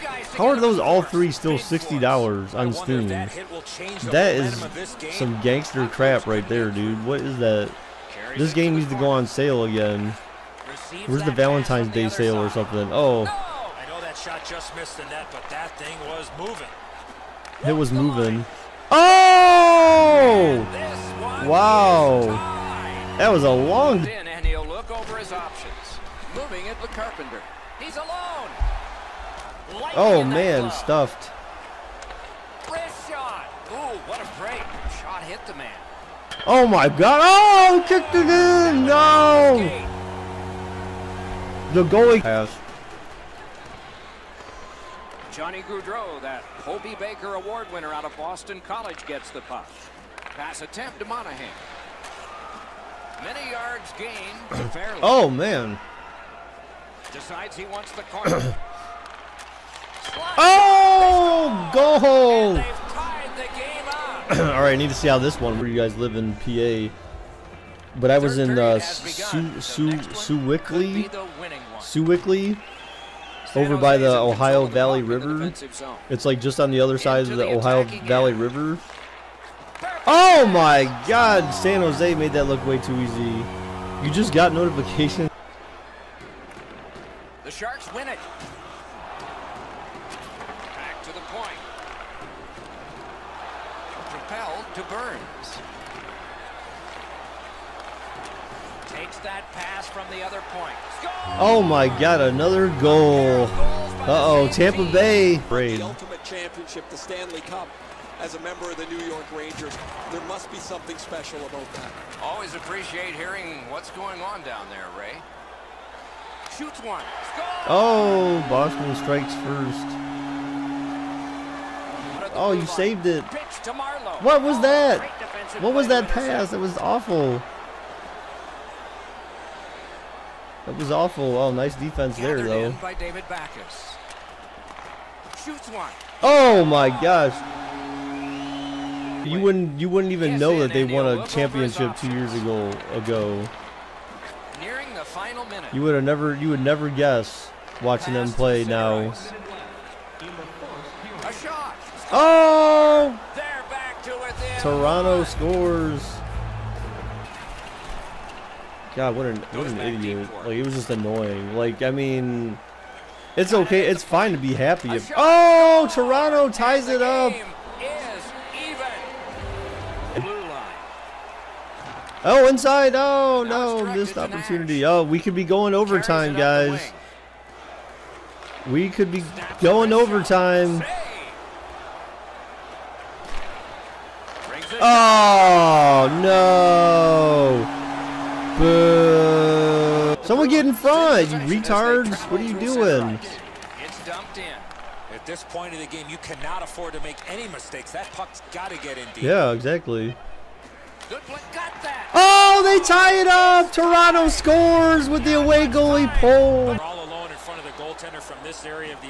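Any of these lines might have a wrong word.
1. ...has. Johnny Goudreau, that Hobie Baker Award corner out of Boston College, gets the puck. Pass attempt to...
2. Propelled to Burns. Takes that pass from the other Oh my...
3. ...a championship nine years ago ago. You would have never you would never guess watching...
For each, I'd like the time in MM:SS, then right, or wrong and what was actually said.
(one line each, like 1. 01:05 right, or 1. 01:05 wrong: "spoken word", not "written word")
1. 00:42 wrong: "winner", not "corner"
2. 01:34 right
3. 02:21 wrong: "two", not "nine".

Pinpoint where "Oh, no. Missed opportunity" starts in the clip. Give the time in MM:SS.
02:52.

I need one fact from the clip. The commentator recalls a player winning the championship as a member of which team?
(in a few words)
New York Rangers.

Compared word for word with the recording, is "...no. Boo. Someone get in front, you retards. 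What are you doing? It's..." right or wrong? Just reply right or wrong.
right.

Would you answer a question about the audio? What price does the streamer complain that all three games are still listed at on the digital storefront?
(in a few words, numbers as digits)
$60.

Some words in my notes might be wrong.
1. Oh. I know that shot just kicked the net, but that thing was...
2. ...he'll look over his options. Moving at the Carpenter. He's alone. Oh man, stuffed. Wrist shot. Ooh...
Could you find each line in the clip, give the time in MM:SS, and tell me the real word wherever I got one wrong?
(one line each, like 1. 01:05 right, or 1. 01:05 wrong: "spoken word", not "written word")
1. 00:12 wrong: "missed", not "kicked"
2. 00:24 right.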